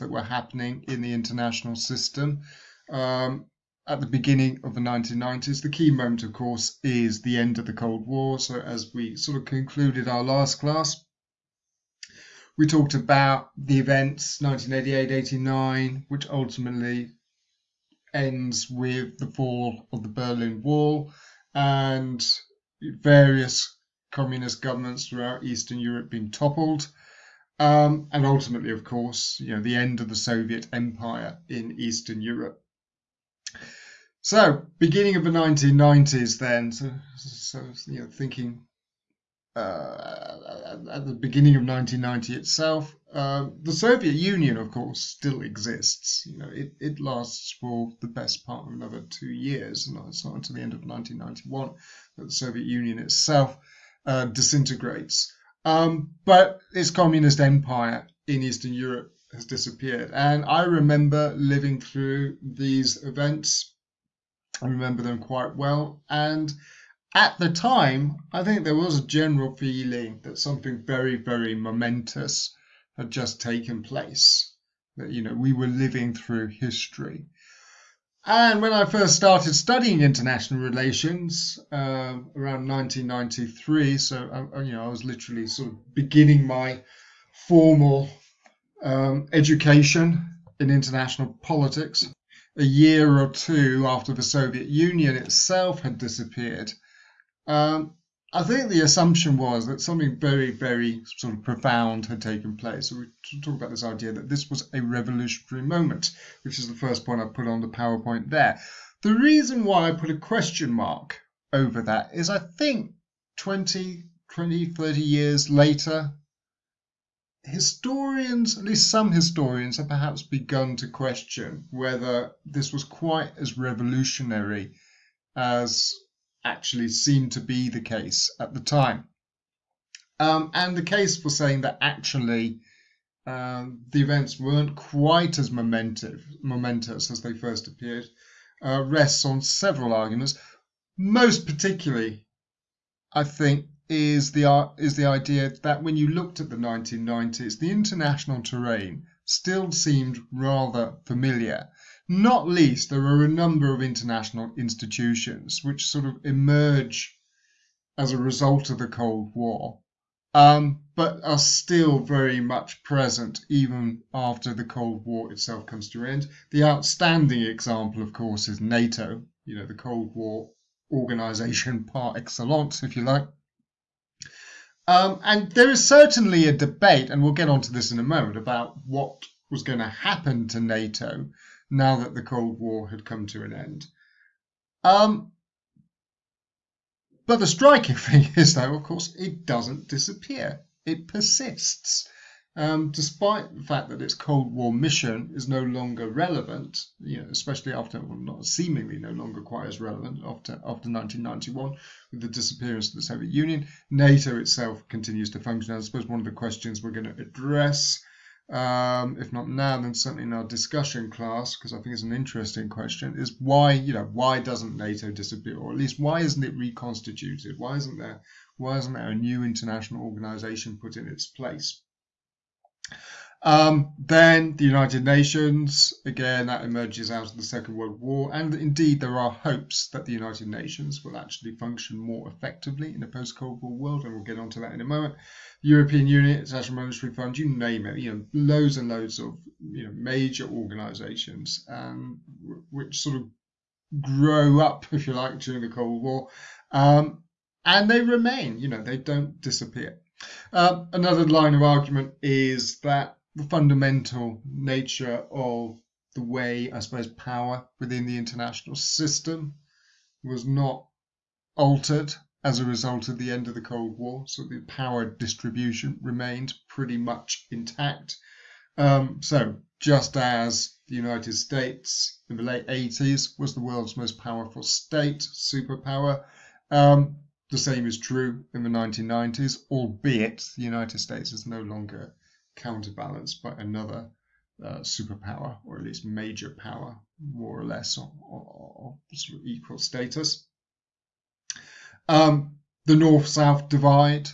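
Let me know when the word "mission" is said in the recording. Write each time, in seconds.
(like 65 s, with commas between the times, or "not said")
194 s.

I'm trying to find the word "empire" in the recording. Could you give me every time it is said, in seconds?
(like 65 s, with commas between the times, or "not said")
30 s, 57 s.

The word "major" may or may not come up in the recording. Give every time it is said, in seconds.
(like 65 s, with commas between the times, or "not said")
239 s, 286 s.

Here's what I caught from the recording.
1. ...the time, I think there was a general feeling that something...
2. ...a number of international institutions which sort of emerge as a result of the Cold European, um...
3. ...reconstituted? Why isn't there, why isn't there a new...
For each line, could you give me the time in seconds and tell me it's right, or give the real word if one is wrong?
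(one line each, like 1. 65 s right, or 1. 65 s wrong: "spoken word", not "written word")
1. 67 s right
2. 153 s wrong: "War", not "European"
3. 216 s right.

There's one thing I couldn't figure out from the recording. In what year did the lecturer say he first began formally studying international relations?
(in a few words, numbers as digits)
1993.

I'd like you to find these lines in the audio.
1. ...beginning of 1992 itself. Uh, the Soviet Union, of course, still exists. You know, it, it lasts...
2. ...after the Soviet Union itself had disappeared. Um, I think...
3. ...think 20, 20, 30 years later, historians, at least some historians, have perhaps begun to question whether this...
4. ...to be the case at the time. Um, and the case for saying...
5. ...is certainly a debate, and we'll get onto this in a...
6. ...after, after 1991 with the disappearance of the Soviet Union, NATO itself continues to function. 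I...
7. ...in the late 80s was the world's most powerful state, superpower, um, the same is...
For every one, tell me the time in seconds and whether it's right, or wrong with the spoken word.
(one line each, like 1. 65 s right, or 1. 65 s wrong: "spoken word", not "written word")
1. 41 s wrong: "1990", not "1992"
2. 93 s right
3. 112 s right
4. 127 s right
5. 175 s right
6. 200 s right
7. 272 s right.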